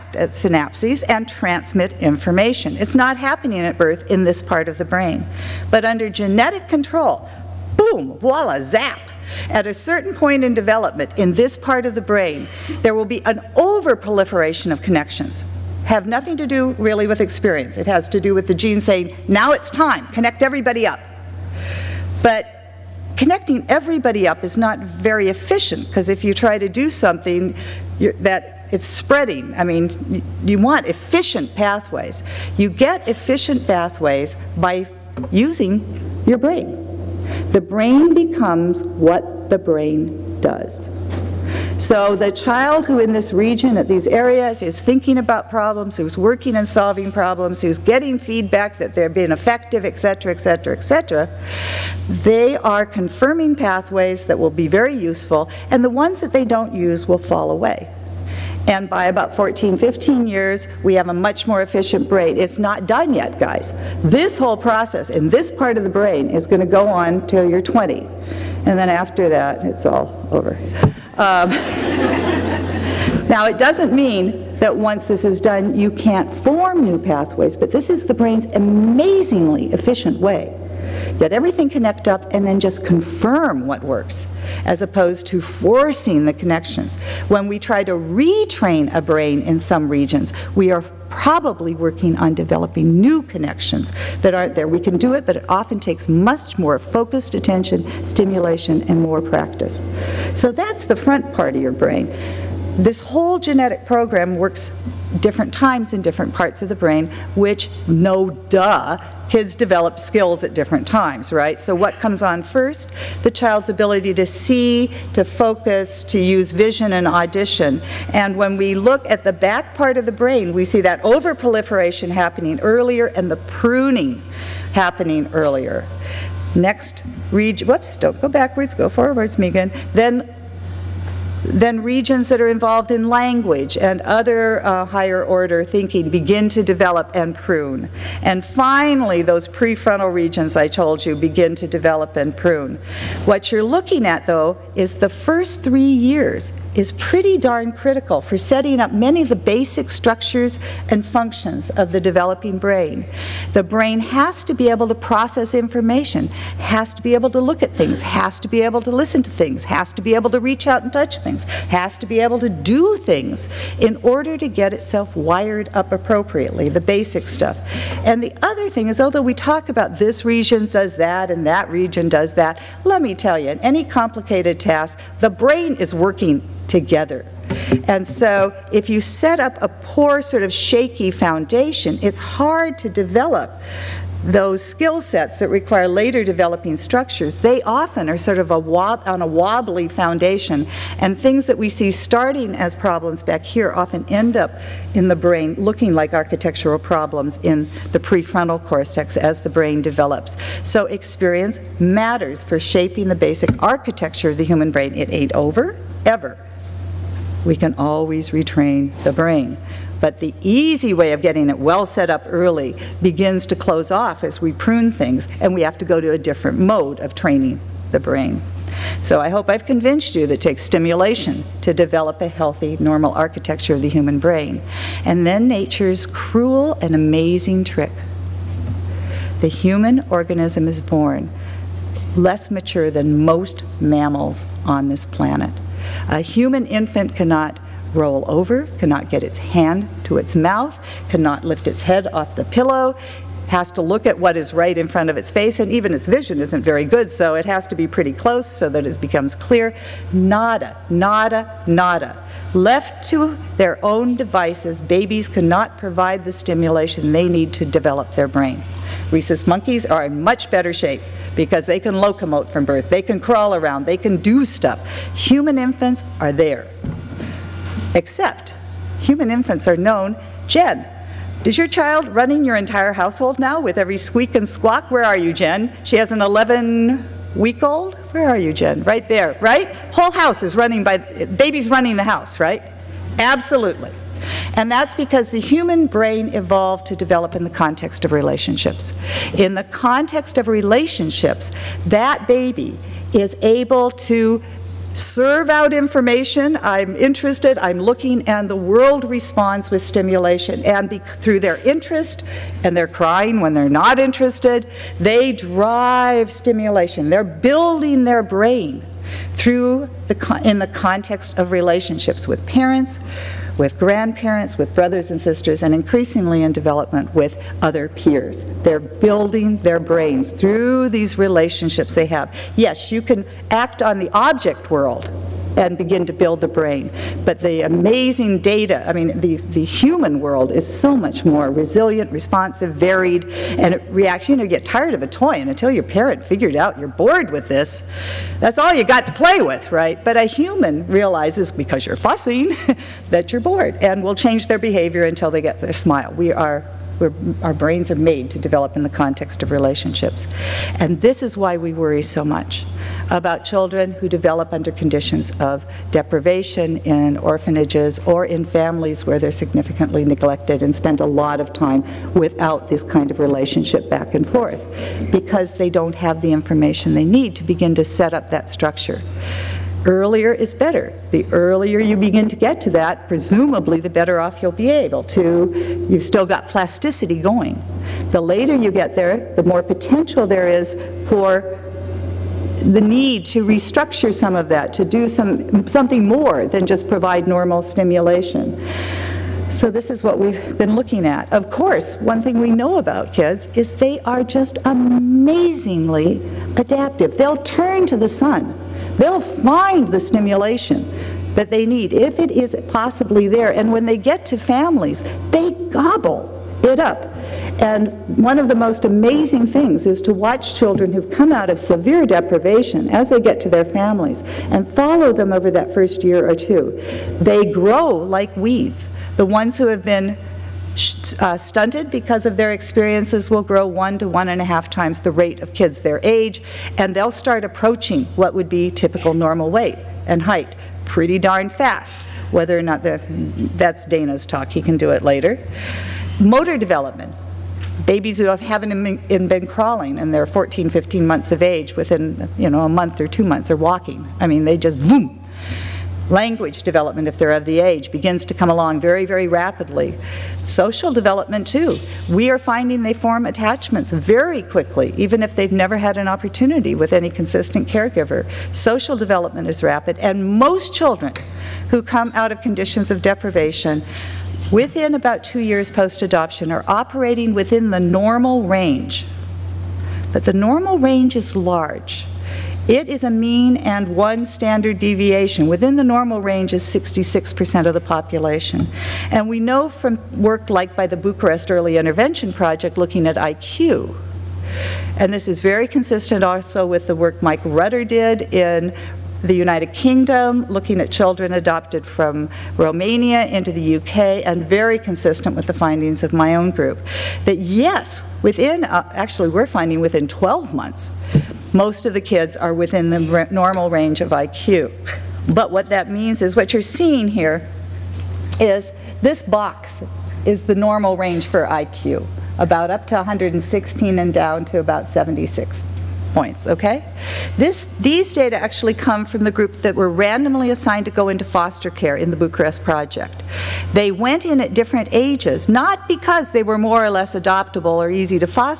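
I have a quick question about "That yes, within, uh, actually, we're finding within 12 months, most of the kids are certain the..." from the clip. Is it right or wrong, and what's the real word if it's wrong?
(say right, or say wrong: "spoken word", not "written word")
wrong: "within", not "certain".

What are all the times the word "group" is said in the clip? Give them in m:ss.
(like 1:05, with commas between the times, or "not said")
8:16, 8:39.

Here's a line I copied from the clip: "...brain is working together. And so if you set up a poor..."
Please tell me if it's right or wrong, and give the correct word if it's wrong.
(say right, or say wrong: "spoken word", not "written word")
right.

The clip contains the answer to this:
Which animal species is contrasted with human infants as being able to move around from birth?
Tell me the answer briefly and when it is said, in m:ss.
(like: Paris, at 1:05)
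Rhesus monkeys, at 4:19.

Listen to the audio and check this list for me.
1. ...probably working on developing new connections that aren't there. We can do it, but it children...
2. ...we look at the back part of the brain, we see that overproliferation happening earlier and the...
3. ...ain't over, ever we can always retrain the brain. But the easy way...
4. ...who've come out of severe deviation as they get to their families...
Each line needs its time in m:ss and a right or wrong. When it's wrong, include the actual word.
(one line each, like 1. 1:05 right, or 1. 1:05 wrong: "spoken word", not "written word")
1. 1:31 wrong: "often", not "children"
2. 1:58 right
3. 3:25 right
4. 6:50 wrong: "deprivation", not "deviation".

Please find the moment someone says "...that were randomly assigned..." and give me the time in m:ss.
8:39.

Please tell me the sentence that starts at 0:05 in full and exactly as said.
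But under genetic control, boom, voila, zap.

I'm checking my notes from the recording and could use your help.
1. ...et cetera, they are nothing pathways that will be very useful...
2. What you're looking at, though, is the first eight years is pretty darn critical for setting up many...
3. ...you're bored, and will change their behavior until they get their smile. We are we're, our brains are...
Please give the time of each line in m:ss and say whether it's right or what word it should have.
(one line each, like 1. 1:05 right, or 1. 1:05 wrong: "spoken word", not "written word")
1. 0:50 wrong: "confirming", not "nothing"
2. 2:23 wrong: "three", not "eight"
3. 5:43 right.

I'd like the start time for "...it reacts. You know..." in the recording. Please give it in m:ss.
5:33.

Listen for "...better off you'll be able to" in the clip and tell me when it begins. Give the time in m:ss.
6:13.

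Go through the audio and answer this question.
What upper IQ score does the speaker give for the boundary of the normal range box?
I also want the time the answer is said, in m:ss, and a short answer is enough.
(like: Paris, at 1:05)
116, at 8:32.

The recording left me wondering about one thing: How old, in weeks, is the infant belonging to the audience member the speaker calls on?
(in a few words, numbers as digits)
11.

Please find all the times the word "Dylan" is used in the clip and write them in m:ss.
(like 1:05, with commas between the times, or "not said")
not said.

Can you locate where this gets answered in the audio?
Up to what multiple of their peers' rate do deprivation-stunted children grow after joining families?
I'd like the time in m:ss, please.
7:04.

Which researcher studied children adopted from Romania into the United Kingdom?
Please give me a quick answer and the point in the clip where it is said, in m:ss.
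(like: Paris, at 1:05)
Mike Rutter, at 8:07.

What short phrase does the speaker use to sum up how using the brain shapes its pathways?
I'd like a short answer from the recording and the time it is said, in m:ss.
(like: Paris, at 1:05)
The brain becomes what the brain does, at 0:37.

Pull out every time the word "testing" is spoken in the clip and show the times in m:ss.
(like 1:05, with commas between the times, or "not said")
not said.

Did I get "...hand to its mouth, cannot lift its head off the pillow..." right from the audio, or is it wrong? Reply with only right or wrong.
right.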